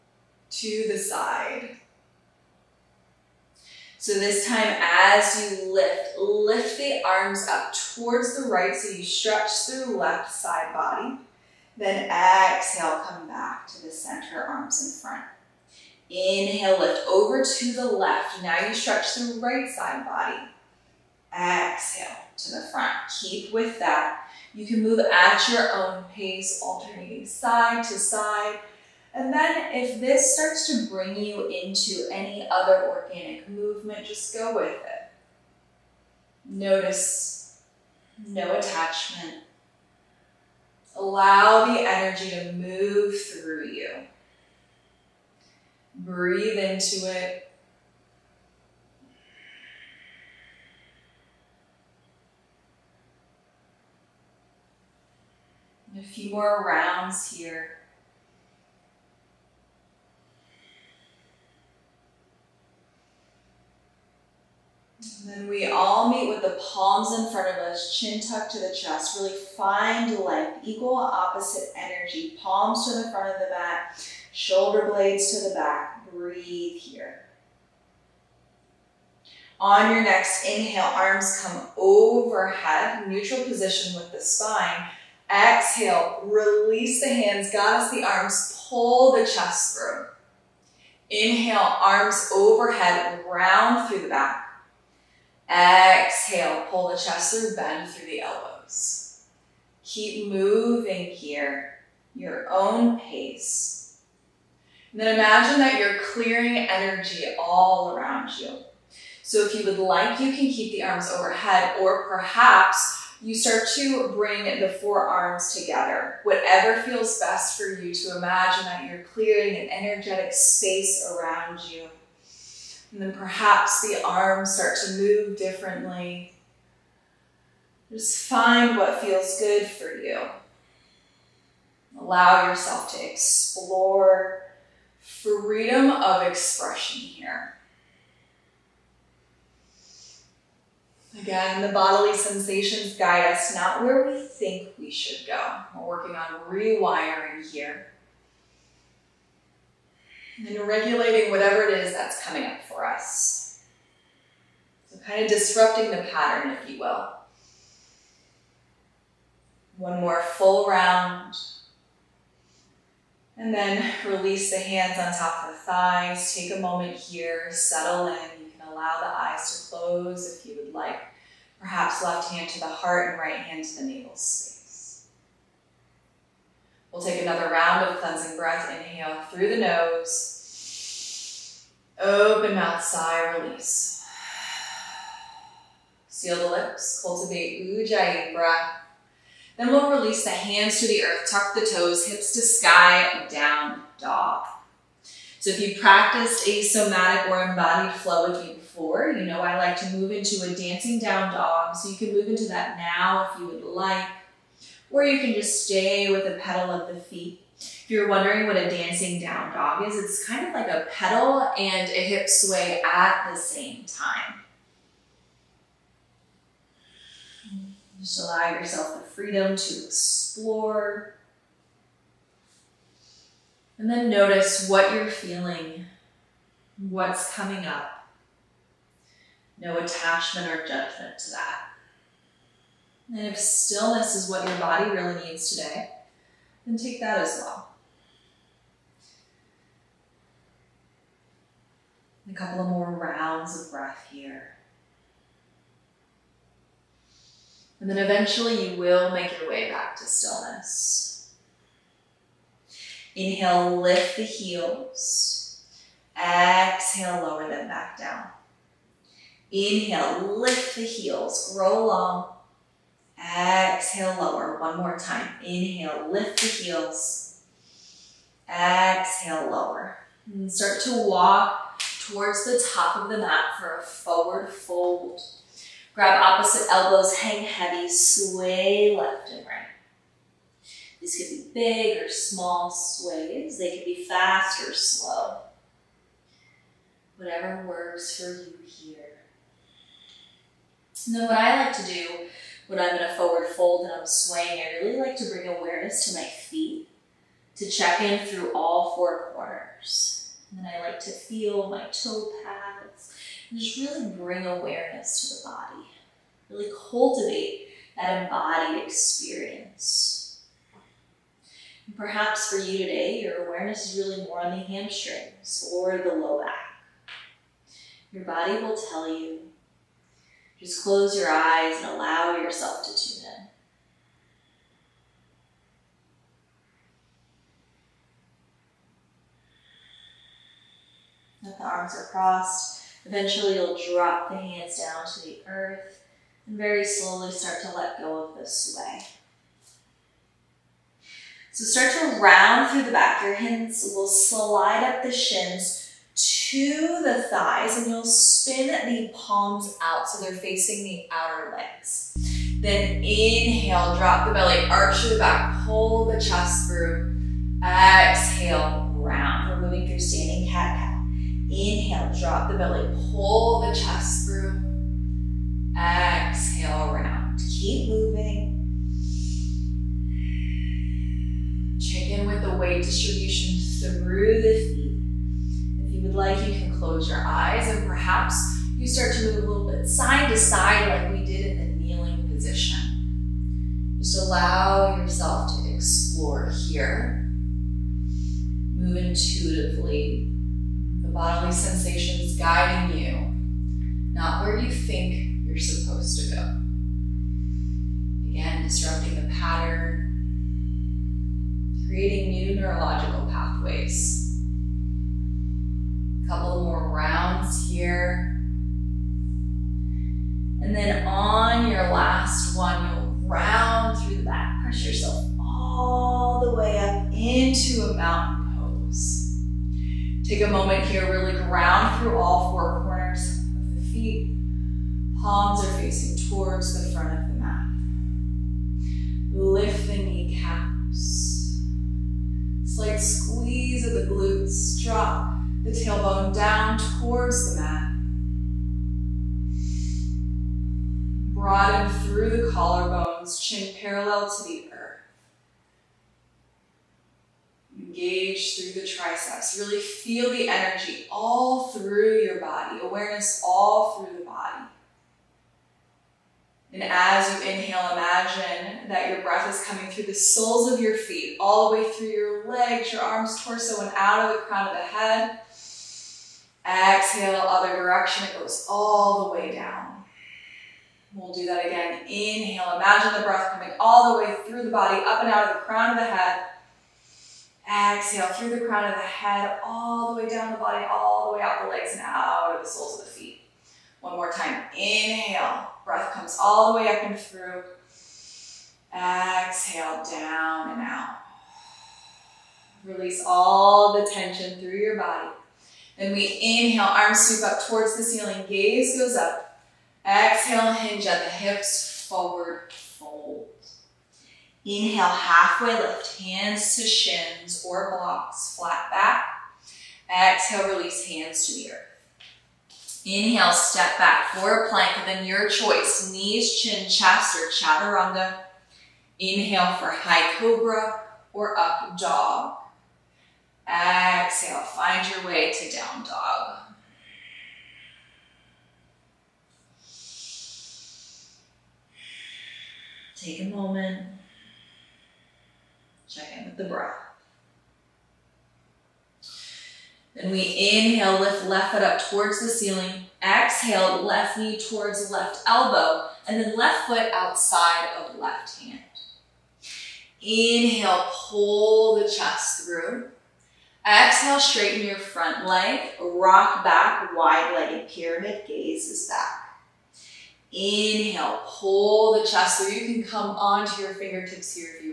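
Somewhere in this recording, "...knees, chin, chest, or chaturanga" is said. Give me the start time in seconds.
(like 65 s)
516 s.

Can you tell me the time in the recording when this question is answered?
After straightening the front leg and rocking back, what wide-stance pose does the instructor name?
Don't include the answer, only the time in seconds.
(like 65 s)
557 s.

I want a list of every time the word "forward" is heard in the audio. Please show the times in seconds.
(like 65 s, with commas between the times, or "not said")
273 s, 293 s, 502 s.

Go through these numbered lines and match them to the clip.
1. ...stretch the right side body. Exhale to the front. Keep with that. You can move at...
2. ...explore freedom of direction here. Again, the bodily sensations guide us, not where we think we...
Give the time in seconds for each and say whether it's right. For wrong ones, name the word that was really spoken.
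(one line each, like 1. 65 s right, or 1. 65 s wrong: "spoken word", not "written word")
1. 18 s right
2. 133 s wrong: "expression", not "direction".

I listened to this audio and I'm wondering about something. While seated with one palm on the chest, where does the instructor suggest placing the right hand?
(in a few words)
Navel space.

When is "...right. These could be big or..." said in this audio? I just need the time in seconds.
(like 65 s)
279 s.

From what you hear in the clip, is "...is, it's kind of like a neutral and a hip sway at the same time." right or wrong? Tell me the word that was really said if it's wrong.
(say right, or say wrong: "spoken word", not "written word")
wrong: "pedal", not "neutral".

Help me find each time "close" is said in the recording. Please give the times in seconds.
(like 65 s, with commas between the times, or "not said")
169 s, 320 s, 376 s.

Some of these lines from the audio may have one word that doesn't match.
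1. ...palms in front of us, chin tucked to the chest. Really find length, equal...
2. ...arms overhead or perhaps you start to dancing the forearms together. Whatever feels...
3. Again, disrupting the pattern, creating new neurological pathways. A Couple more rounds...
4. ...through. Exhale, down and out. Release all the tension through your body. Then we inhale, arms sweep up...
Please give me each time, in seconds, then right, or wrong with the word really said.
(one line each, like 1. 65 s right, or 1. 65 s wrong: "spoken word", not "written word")
1. 66 s right
2. 110 s wrong: "bring", not "dancing"
3. 398 s right
4. 487 s right.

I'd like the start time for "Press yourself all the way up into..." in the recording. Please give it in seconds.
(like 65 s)
414 s.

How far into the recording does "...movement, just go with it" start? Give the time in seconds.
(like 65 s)
33 s.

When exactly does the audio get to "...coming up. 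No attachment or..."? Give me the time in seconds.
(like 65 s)
227 s.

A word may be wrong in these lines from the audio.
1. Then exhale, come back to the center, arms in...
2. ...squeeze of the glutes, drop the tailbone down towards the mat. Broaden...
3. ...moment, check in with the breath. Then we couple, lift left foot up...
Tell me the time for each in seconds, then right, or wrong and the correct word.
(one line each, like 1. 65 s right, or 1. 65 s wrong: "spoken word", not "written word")
1. 11 s right
2. 432 s right
3. 533 s wrong: "inhale", not "couple".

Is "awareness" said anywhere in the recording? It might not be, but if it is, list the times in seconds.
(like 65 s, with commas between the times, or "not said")
295 s, 304 s, 313 s, 452 s.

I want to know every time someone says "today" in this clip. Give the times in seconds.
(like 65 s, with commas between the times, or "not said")
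235 s, 312 s.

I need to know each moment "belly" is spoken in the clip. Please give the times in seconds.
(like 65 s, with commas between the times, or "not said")
354 s, 362 s.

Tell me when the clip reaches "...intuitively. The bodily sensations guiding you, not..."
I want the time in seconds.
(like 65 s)
388 s.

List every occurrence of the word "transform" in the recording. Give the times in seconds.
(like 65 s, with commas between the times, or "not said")
not said.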